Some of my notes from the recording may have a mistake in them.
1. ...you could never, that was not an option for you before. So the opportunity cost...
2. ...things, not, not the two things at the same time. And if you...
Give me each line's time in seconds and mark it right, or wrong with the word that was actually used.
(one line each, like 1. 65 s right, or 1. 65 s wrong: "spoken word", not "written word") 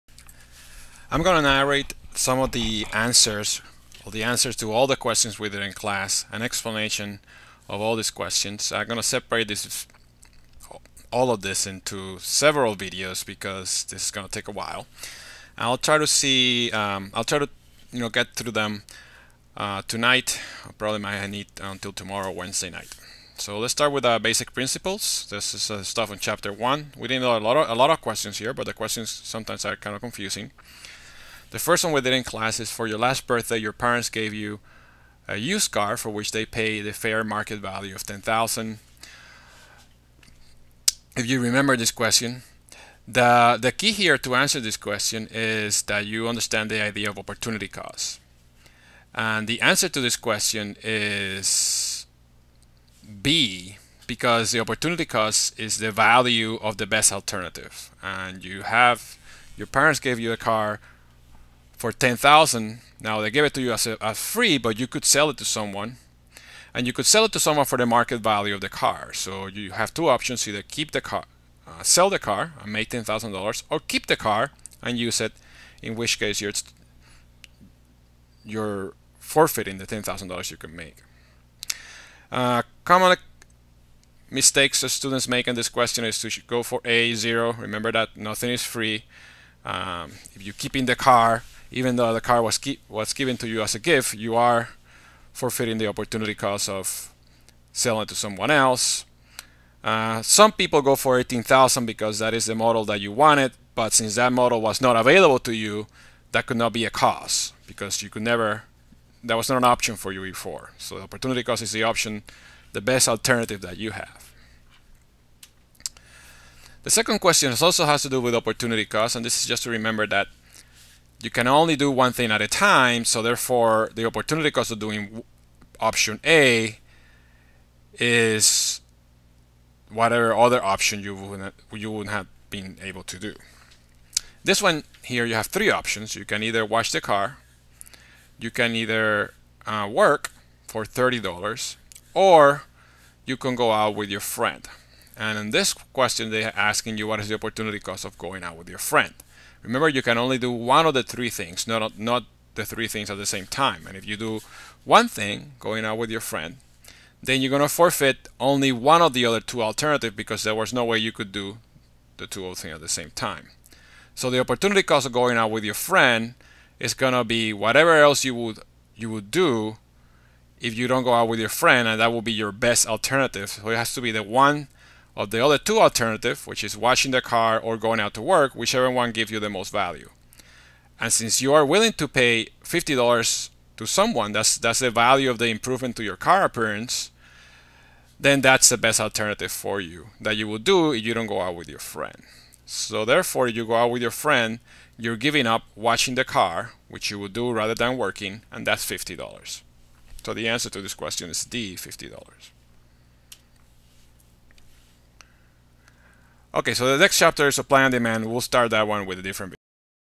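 1. 108 s right
2. 151 s wrong: "three", not "two".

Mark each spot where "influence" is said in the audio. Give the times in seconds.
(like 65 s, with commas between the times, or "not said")
not said.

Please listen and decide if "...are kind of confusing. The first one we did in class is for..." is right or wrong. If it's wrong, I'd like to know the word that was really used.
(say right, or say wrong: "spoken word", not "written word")
right.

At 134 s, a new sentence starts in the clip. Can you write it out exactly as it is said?
This one here, you have three options.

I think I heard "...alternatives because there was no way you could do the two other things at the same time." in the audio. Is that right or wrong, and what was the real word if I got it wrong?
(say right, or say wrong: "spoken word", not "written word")
right.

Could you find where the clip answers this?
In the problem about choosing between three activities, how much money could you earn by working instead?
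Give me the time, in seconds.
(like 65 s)
140 s.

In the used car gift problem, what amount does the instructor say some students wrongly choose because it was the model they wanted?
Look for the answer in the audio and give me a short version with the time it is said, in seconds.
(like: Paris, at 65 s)
18,000, at 101 s.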